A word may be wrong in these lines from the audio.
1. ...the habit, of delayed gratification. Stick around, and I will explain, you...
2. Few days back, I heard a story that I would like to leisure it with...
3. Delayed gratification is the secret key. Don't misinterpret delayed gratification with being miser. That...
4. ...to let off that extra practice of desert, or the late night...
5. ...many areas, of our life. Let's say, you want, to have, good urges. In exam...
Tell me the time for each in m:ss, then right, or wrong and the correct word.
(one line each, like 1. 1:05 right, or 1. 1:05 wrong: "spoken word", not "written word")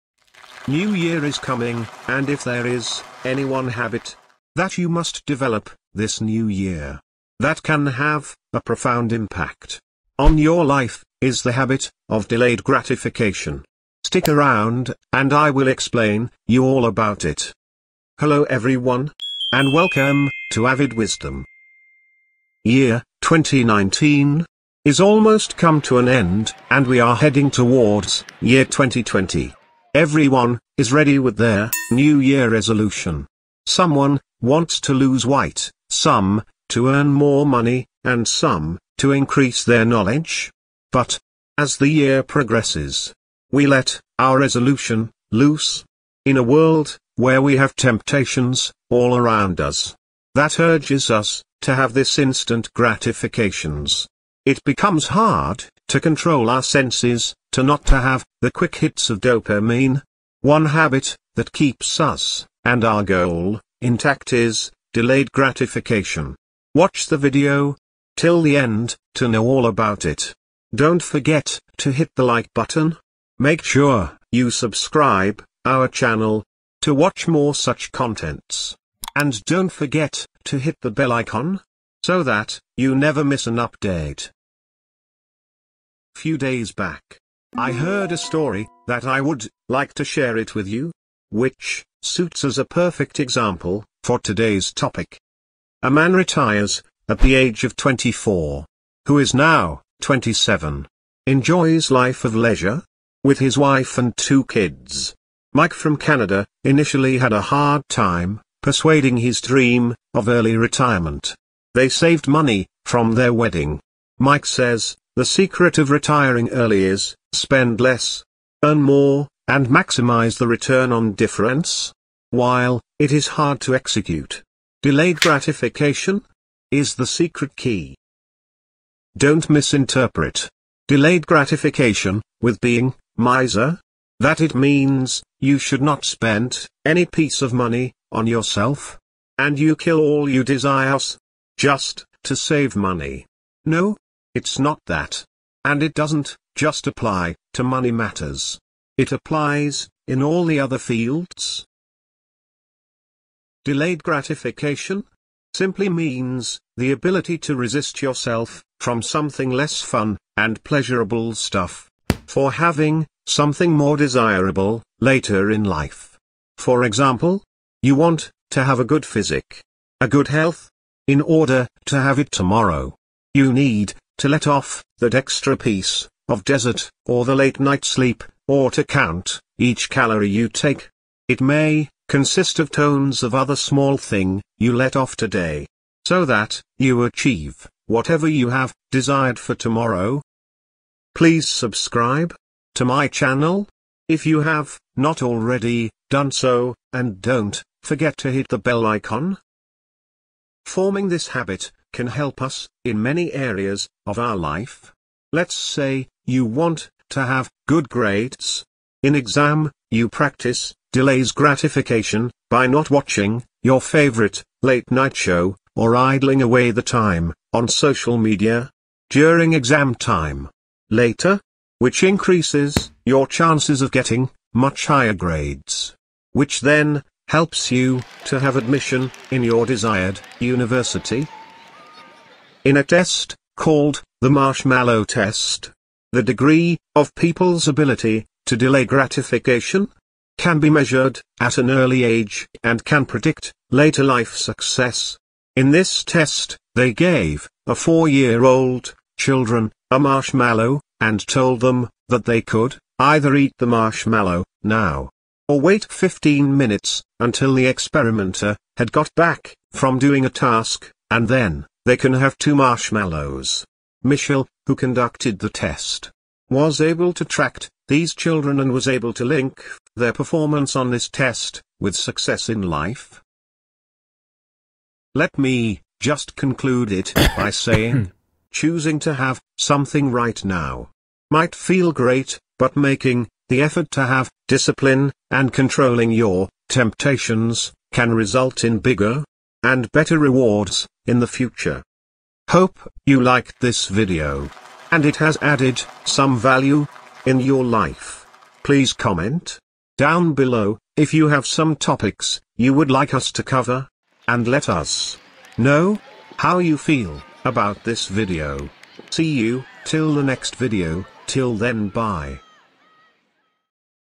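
1. 0:11 right
2. 1:26 wrong: "share", not "leisure"
3. 2:04 right
4. 2:54 wrong: "piece", not "practice"
5. 3:23 wrong: "grades", not "urges".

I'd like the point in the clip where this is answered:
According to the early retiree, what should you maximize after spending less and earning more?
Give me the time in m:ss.
2:00.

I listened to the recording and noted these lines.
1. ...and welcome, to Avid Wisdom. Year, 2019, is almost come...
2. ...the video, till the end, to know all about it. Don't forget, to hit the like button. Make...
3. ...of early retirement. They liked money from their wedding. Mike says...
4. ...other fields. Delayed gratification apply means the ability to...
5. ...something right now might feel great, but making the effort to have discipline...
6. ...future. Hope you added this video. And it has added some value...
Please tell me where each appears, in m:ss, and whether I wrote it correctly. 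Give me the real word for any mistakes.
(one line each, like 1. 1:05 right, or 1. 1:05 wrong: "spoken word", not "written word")
1. 0:19 right
2. 1:07 right
3. 1:50 wrong: "saved", not "liked"
4. 2:30 wrong: "simply", not "apply"
5. 4:39 right
6. 4:51 wrong: "liked", not "added".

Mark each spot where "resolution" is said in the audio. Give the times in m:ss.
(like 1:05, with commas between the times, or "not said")
0:32, 0:44.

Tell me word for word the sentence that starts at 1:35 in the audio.
A man retires at the age of 24, who is now 27, enjoys life of leisure with his wife and two kids.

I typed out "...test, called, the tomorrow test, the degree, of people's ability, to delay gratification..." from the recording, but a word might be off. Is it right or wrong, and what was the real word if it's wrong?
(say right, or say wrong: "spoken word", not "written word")
wrong: "marshmallow", not "tomorrow".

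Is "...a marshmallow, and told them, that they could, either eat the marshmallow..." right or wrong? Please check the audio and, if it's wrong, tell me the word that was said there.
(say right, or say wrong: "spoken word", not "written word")
right.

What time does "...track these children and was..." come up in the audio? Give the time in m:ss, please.
4:27.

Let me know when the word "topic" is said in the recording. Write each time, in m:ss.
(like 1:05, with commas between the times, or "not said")
1:34, 5:01.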